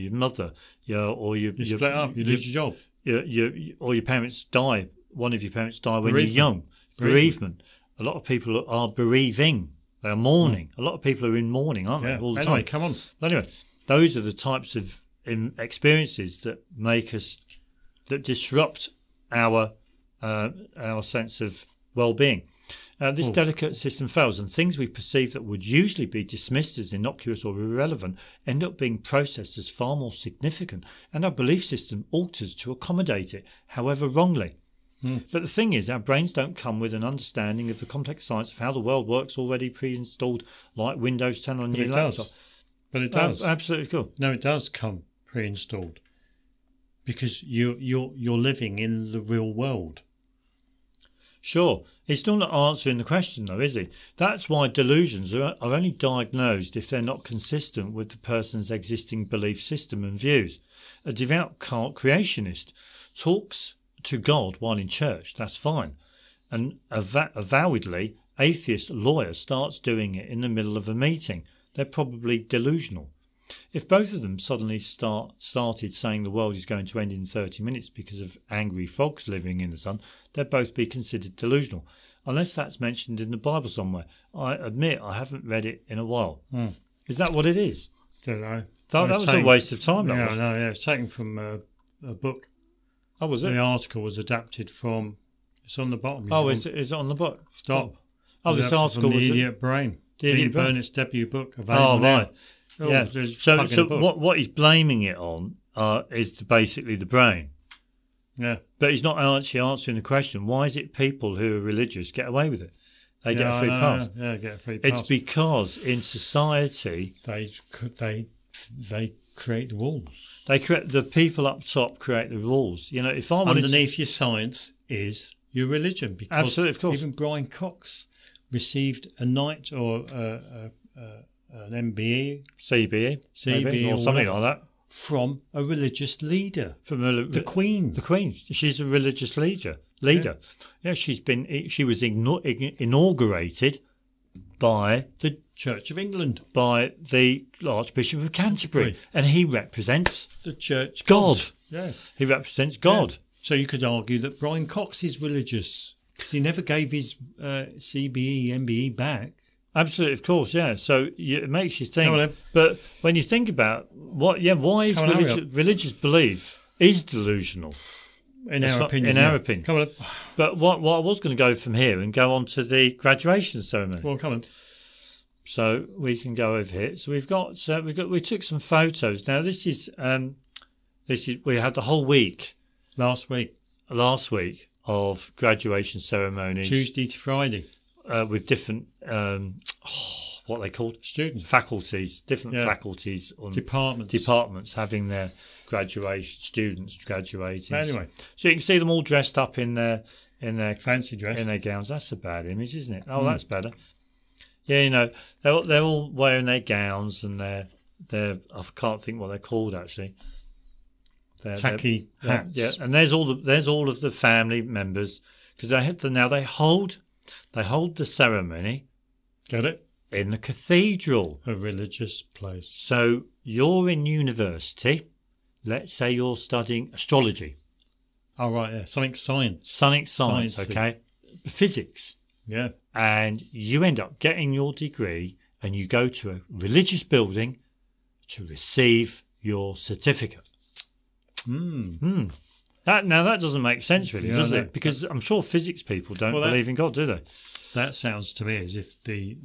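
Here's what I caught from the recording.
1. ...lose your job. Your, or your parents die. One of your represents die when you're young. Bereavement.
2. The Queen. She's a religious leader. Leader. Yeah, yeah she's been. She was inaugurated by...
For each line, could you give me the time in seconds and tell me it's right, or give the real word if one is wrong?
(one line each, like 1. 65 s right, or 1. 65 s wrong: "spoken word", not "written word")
1. 2 s wrong: "parents", not "represents"
2. 137 s right.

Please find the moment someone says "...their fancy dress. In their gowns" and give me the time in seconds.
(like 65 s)
200 s.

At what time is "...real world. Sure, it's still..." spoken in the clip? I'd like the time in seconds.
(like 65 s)
49 s.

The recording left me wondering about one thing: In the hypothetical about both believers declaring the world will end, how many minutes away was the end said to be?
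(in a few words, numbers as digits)
30.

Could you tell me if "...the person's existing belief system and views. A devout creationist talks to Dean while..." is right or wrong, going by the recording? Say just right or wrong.
wrong.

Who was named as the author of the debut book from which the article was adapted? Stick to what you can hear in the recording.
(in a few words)
Dean Burnett.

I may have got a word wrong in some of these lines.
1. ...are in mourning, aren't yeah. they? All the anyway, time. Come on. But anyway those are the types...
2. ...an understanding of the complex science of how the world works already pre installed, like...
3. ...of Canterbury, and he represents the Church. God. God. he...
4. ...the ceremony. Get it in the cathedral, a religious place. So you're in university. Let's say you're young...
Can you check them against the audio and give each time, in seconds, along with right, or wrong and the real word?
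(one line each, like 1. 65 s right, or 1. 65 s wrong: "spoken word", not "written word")
1. 11 s right
2. 36 s right
3. 148 s right
4. 217 s wrong: "studying", not "young".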